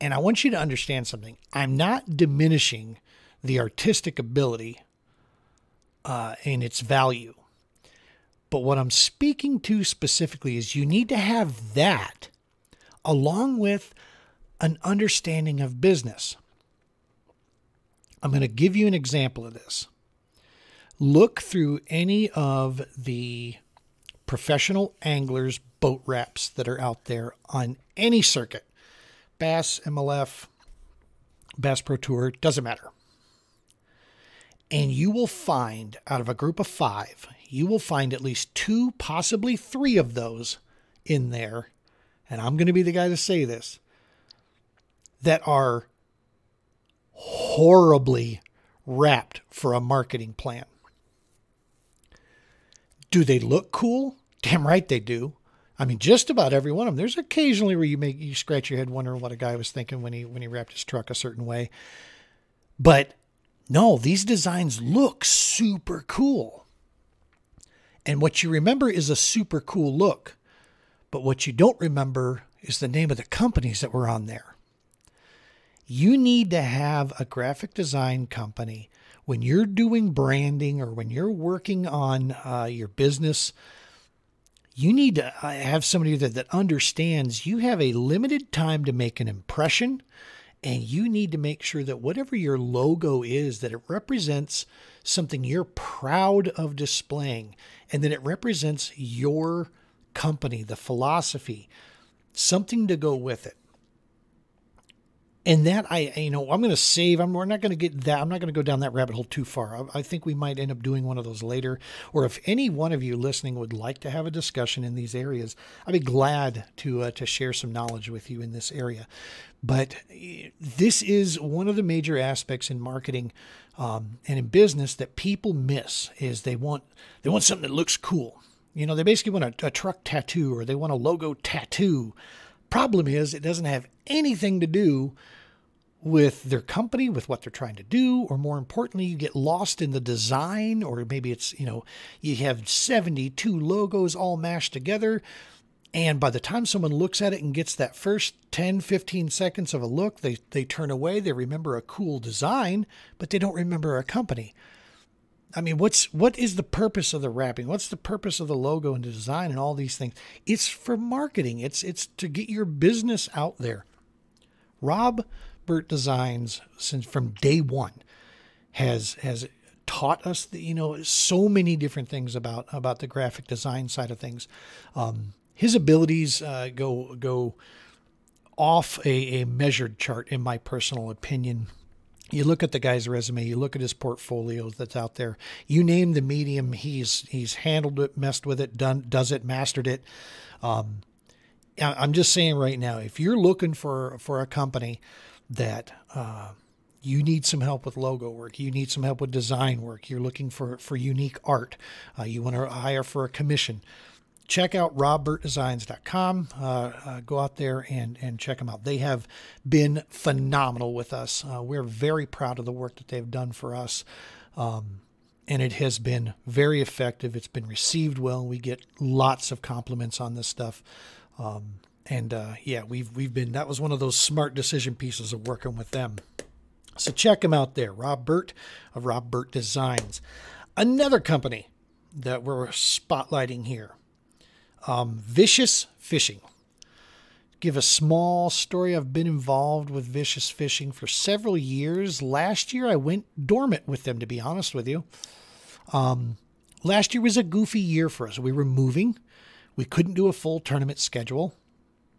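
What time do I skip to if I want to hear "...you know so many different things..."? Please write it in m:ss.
2:50.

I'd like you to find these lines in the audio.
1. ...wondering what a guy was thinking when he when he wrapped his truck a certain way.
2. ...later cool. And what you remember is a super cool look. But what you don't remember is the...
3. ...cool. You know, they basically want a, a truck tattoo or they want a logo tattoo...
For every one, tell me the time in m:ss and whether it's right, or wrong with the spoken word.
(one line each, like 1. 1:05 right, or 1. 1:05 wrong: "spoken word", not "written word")
1. 0:58 right
2. 1:05 wrong: "super", not "later"
3. 2:07 right.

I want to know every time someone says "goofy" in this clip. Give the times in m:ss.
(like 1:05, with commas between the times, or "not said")
4:07.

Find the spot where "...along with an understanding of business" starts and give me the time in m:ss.
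0:13.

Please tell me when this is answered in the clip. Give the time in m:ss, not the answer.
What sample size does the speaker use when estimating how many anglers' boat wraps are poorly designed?
0:36.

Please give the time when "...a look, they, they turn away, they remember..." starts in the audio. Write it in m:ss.
2:29.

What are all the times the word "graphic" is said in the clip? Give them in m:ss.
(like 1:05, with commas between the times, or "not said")
1:17, 2:53.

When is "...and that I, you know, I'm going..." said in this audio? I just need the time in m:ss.
1:45.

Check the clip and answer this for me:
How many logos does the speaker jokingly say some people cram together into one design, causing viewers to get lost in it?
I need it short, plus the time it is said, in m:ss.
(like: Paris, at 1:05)
72, at 2:22.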